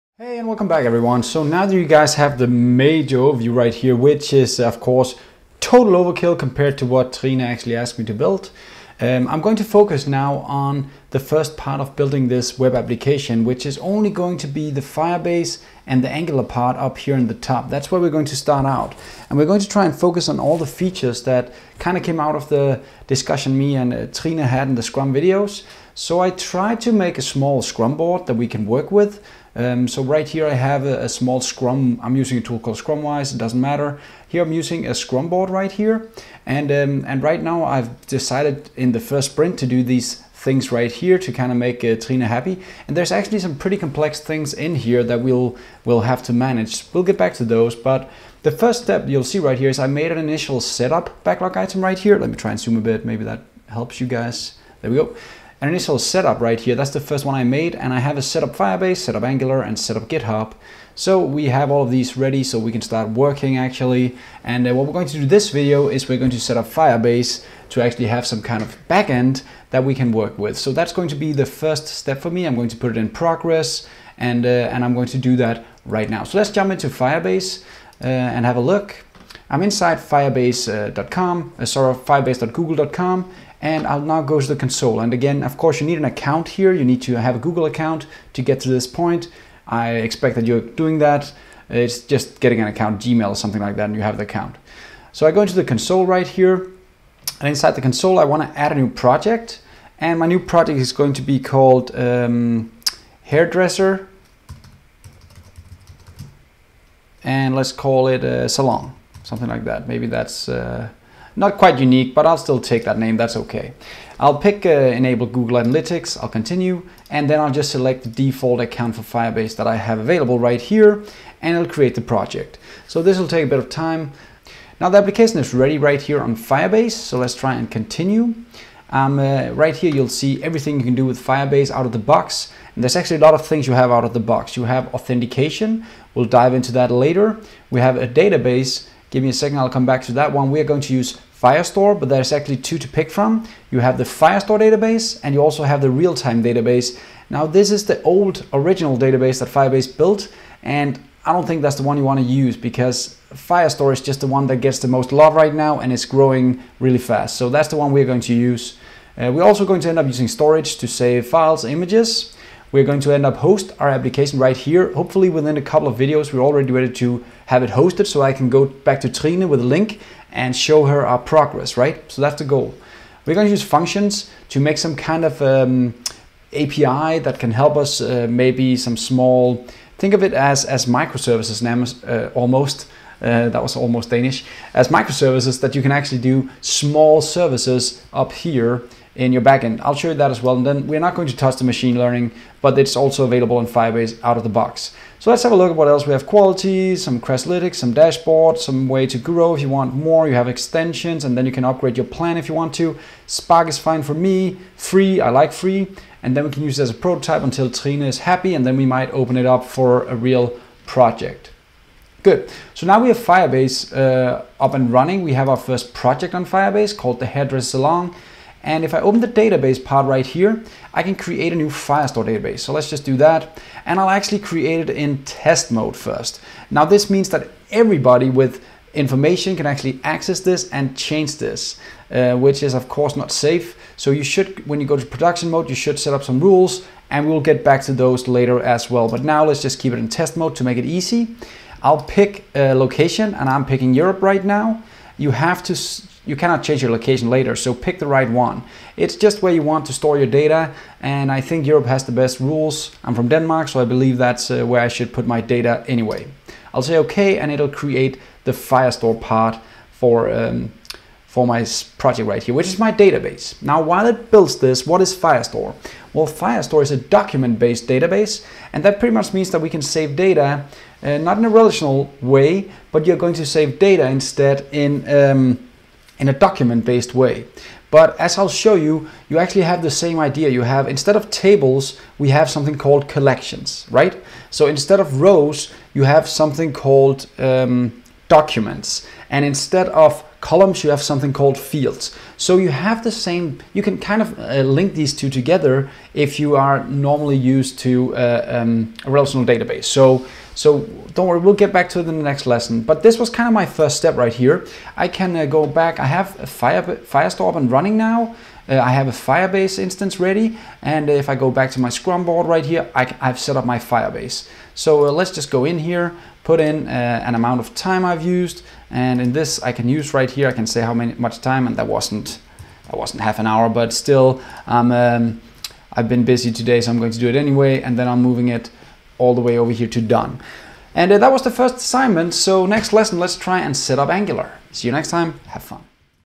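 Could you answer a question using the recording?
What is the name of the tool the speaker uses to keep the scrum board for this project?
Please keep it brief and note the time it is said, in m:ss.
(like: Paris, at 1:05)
Scrumwise, at 0:32.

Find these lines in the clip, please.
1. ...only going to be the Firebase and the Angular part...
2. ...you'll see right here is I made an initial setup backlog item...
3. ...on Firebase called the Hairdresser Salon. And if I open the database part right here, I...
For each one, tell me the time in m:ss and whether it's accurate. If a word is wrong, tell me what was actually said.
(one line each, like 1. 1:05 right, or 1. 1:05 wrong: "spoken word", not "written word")
1. 0:13 right
2. 0:49 right
3. 3:36 right.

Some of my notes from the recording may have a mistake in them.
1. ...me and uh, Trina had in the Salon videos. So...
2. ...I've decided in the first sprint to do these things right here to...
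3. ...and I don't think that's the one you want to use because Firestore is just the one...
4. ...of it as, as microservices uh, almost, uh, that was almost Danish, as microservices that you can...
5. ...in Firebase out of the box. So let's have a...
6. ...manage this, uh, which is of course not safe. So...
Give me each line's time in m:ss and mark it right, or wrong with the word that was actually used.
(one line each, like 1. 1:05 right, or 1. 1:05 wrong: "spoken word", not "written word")
1. 0:23 wrong: "Scrum", not "Salon"
2. 0:37 right
3. 2:30 right
4. 3:00 right
5. 3:13 right
6. 3:50 wrong: "change", not "manage".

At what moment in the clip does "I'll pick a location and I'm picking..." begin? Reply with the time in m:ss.
4:01.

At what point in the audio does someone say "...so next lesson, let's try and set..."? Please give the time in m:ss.
5:32.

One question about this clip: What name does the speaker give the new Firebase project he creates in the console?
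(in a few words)
hairdresser salon.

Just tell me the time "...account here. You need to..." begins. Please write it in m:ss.
1:26.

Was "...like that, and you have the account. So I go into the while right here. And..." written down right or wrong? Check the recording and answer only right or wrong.
wrong.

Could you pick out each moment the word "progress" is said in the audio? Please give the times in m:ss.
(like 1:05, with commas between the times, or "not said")
1:13, 2:51.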